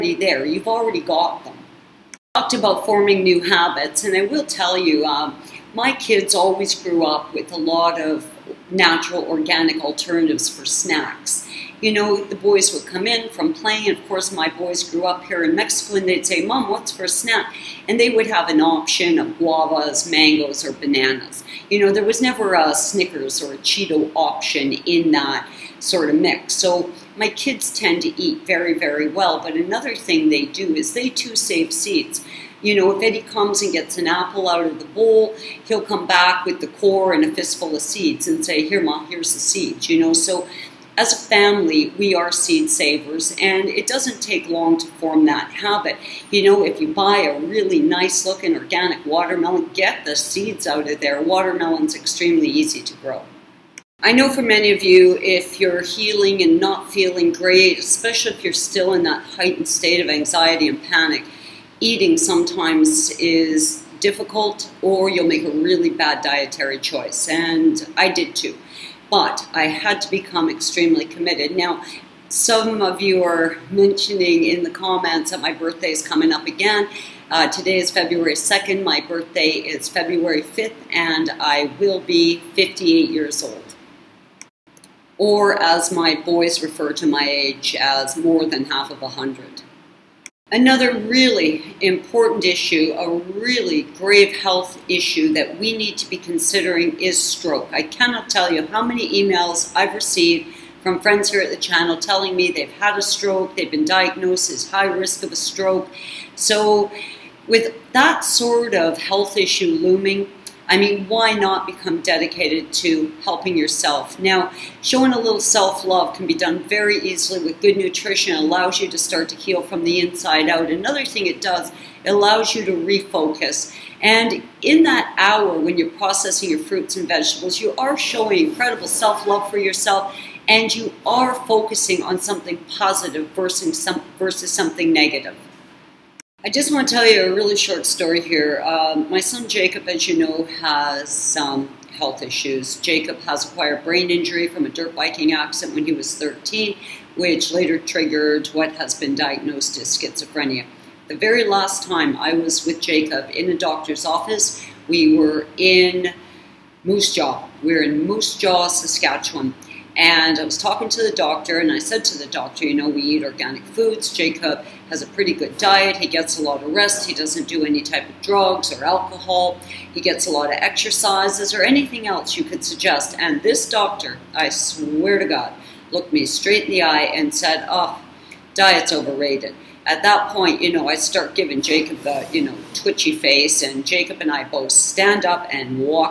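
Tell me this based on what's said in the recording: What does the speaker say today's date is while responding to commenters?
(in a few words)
February 2.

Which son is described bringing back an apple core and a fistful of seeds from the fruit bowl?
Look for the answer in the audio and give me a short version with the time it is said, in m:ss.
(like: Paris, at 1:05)
Eddie, at 0:33.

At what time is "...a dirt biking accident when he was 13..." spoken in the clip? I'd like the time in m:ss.
2:24.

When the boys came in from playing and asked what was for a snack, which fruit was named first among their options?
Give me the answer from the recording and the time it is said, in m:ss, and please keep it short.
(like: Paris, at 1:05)
Guavas, at 0:19.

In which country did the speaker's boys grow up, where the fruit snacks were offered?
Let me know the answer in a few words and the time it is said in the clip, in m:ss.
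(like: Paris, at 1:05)
Mexico, at 0:15.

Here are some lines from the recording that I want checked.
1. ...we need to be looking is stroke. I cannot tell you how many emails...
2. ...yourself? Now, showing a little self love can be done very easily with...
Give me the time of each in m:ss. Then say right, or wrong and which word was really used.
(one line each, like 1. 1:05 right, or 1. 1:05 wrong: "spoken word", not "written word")
1. 1:35 wrong: "considering", not "looking"
2. 1:53 right.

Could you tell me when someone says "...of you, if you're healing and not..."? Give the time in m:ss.
0:54.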